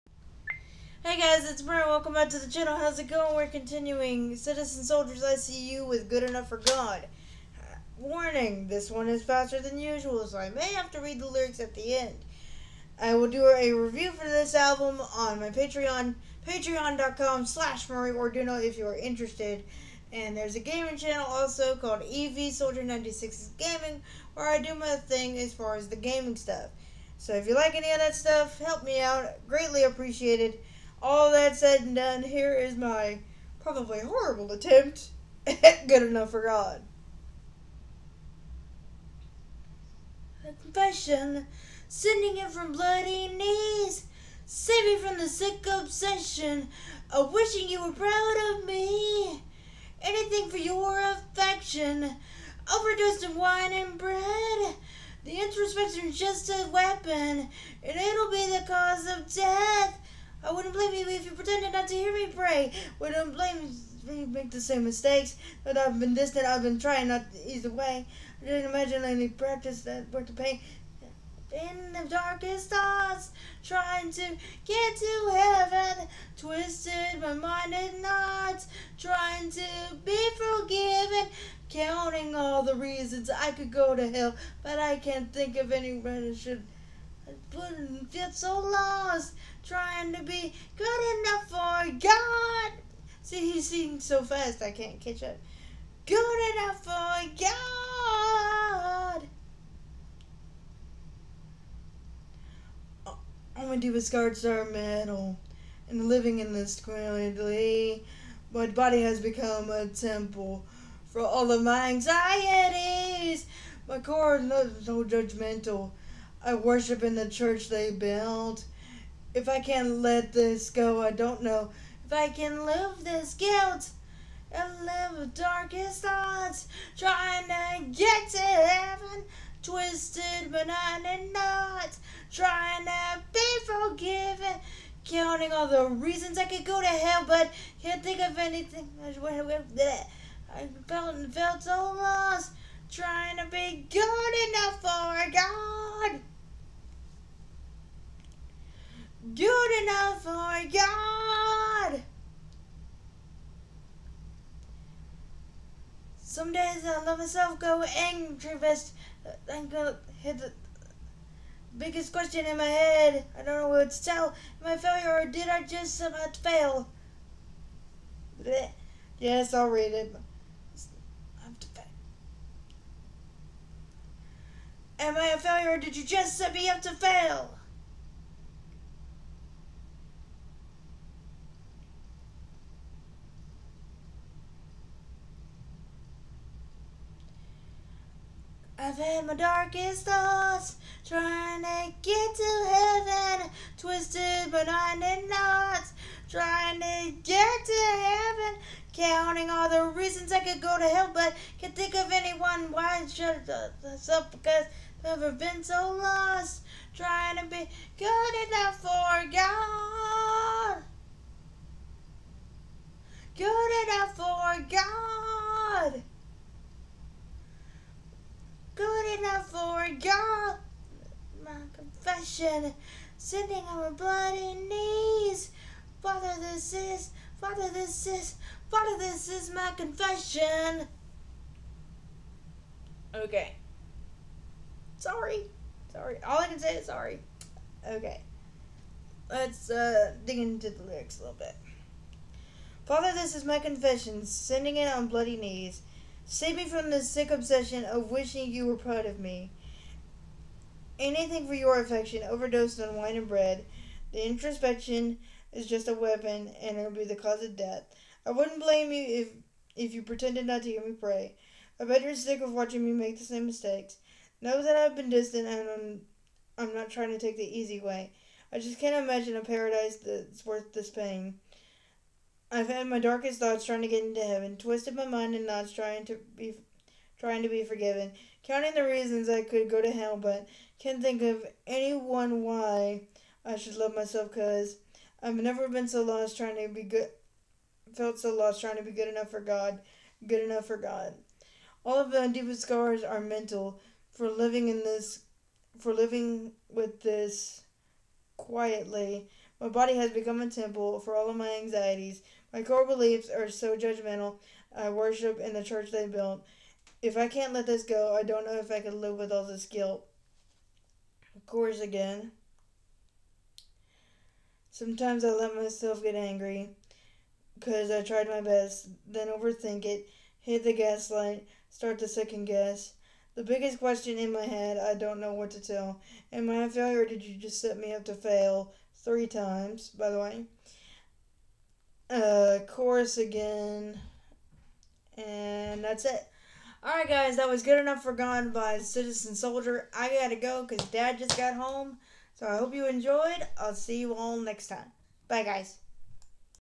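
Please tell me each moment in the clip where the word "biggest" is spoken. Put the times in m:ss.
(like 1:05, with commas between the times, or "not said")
2:41, 5:23.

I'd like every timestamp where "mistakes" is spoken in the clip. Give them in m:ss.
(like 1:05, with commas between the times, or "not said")
1:04, 4:23.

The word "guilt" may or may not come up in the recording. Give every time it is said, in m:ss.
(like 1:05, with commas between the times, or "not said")
2:03, 5:09.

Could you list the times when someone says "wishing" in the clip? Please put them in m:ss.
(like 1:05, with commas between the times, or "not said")
0:47, 4:08.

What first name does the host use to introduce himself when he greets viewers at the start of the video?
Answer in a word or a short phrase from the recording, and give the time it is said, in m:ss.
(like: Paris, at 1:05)
Brent, at 0:01.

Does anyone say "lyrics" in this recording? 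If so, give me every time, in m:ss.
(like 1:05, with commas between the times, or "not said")
0:11, 4:00.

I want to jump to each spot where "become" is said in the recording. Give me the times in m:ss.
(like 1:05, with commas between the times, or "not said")
1:49, 5:00.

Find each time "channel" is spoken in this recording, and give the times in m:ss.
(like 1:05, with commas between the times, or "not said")
0:02, 0:20.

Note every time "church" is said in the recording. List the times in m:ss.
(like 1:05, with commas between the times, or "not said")
1:57, 5:05.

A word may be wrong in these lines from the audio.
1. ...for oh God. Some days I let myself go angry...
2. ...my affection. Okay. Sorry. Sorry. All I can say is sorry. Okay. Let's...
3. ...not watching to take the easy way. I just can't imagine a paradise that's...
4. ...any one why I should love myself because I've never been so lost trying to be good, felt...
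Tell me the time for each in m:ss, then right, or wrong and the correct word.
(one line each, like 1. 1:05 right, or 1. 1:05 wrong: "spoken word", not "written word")
1. 2:30 right
2. 3:49 wrong: "confession", not "affection"
3. 4:26 wrong: "trying", not "watching"
4. 4:41 right.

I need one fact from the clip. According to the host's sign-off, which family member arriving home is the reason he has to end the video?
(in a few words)
Dad.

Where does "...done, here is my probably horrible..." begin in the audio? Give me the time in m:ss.
0:31.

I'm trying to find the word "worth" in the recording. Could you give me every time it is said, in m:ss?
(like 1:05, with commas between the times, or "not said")
1:10, 4:30.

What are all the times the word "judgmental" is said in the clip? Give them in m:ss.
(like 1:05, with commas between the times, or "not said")
1:55, 5:03.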